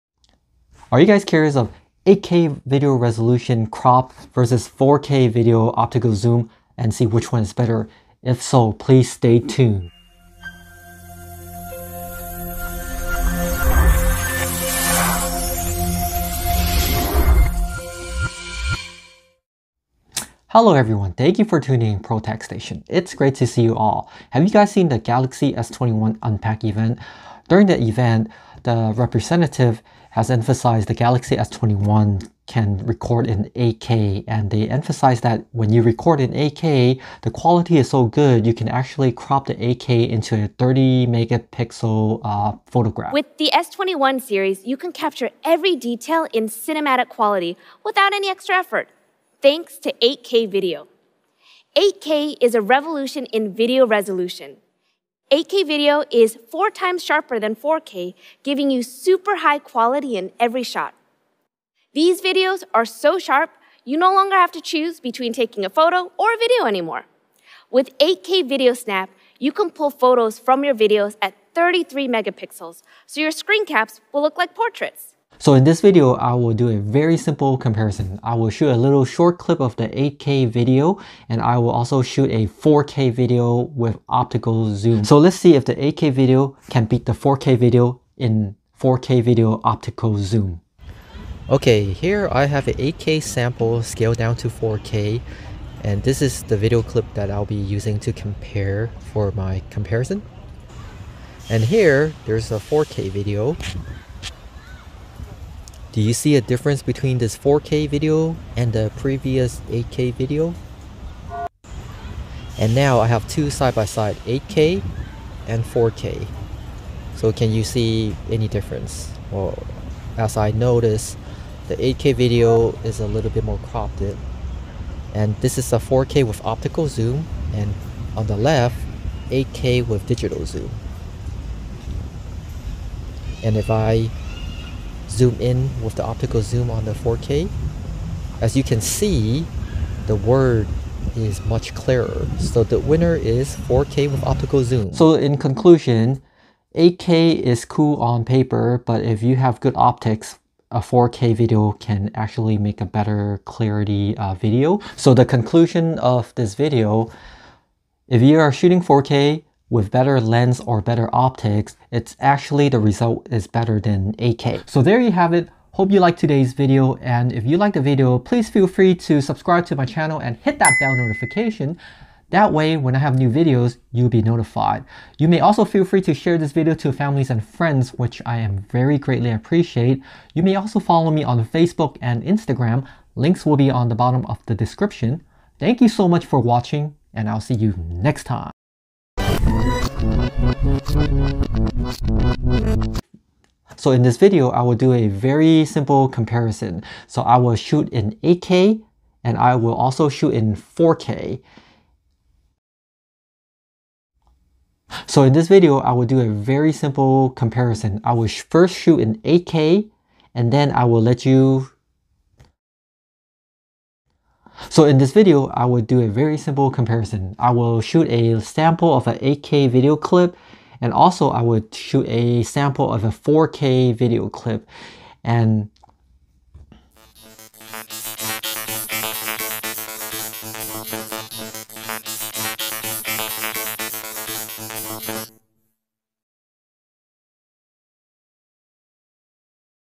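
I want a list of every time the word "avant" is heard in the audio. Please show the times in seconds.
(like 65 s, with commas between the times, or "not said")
not said.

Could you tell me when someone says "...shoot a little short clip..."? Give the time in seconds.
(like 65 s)
78 s.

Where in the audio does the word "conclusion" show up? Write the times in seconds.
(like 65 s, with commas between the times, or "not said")
145 s, 155 s.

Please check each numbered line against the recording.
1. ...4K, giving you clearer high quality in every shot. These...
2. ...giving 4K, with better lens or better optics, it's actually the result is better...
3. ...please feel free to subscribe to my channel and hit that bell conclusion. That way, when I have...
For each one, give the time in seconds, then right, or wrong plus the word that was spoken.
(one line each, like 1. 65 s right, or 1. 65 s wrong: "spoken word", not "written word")
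1. 57 s wrong: "super", not "clearer"
2. 158 s wrong: "shooting", not "giving"
3. 168 s wrong: "notification", not "conclusion".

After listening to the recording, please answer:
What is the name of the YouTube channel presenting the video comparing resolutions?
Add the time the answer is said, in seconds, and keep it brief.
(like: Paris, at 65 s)
ProTec Station, at 22 s.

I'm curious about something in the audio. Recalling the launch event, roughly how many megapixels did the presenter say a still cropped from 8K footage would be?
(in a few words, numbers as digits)
30.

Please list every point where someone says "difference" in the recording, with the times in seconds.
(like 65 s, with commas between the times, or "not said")
106 s, 118 s.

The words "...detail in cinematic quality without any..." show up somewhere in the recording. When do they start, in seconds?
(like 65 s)
45 s.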